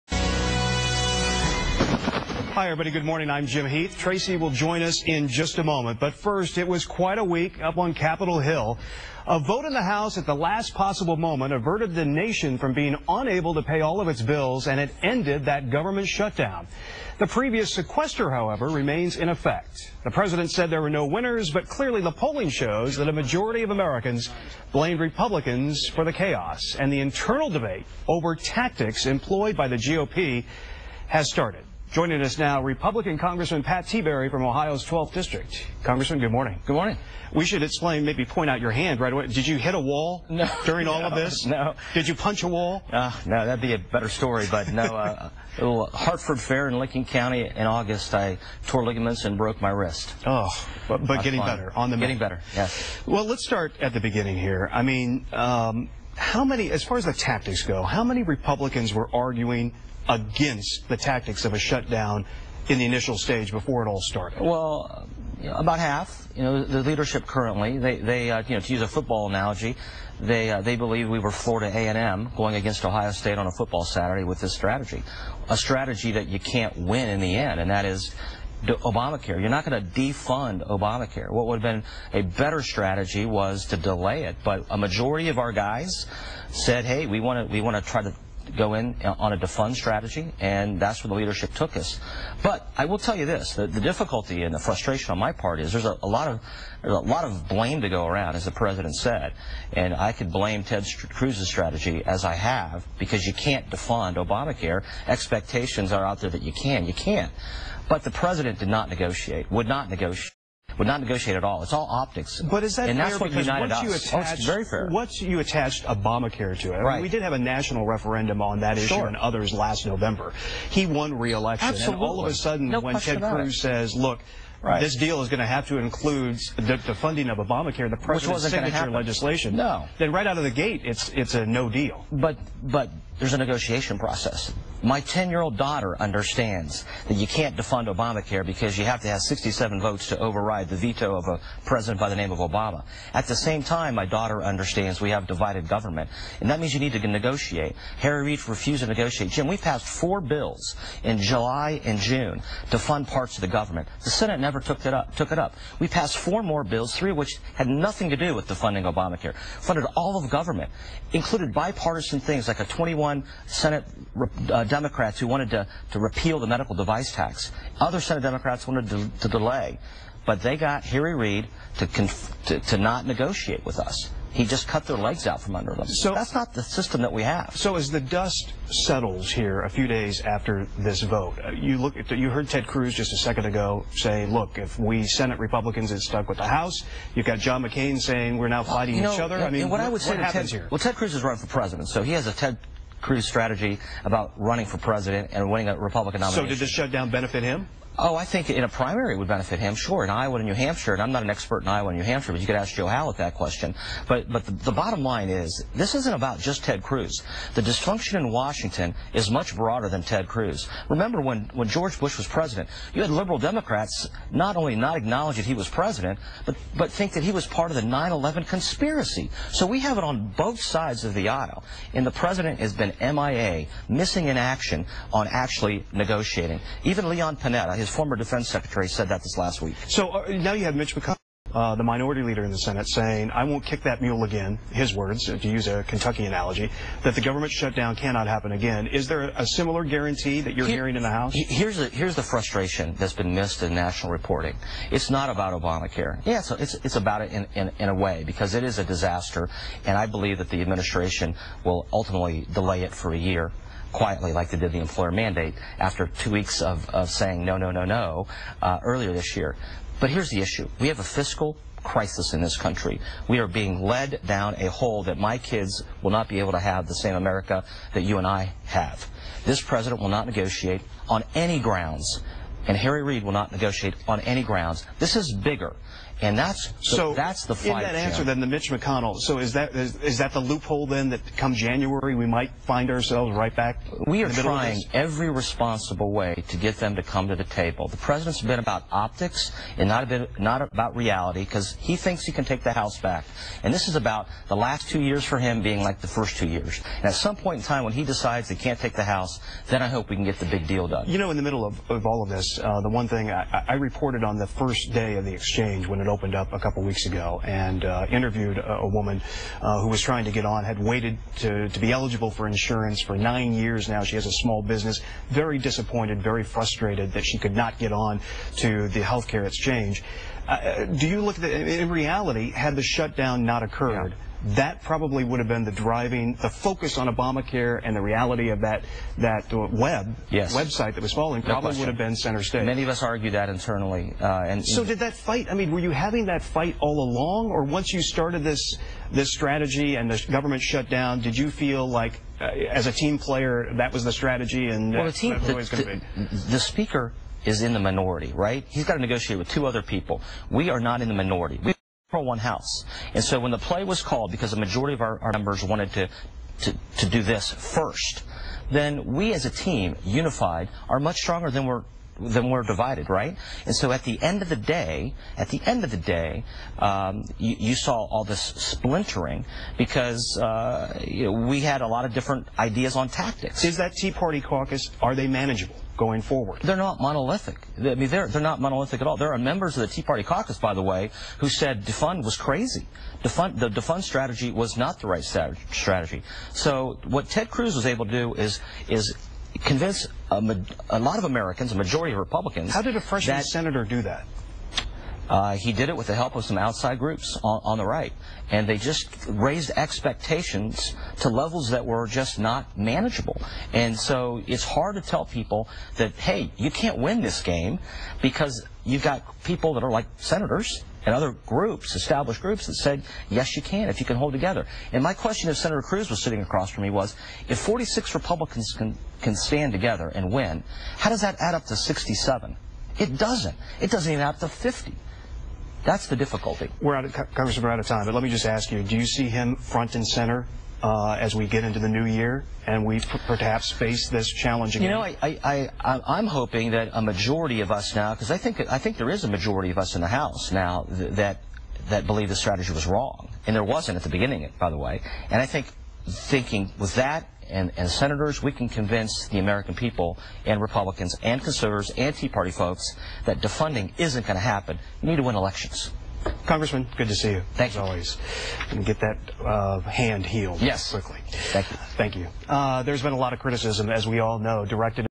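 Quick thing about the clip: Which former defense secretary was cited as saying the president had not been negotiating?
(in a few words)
Leon Panetta.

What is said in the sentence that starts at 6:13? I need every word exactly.
Is that Tea Party caucus, are they manageable?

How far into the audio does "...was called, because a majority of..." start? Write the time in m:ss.
5:53.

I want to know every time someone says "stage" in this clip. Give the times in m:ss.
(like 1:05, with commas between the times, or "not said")
1:03, 5:32.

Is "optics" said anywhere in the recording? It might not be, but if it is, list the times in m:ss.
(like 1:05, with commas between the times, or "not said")
1:51, 4:48.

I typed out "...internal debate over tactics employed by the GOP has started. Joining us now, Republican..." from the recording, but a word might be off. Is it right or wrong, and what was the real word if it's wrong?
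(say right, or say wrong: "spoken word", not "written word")
right.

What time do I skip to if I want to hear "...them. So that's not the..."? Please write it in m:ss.
2:55.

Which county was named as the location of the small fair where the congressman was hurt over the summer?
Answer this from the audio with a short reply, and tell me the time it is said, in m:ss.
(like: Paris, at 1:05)
Licking County, at 0:46.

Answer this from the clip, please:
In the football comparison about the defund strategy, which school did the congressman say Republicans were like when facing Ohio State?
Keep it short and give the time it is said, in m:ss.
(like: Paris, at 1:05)
Florida A&M, at 1:11.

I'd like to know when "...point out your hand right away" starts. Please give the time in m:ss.
0:38.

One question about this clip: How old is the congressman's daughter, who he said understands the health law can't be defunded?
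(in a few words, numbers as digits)
10.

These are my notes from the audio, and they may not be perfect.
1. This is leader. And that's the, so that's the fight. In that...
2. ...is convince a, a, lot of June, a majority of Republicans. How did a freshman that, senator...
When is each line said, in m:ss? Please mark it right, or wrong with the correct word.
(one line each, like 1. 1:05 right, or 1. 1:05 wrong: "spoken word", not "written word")
1. 4:34 wrong: "bigger", not "leader"
2. 6:28 wrong: "Americans", not "June".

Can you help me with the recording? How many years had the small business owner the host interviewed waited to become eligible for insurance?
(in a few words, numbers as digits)
9.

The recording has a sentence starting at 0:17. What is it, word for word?
The previous sequester, however, remains in effect.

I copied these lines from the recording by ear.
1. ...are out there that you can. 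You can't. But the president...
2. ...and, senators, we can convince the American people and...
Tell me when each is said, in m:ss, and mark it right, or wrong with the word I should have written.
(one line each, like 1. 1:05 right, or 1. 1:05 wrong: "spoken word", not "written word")
1. 1:45 right
2. 7:27 right.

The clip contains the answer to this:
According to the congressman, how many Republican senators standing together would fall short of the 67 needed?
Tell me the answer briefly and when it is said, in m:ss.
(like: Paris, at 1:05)
46, at 6:57.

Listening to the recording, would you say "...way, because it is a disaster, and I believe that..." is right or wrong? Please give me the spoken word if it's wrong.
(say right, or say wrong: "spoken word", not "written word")
right.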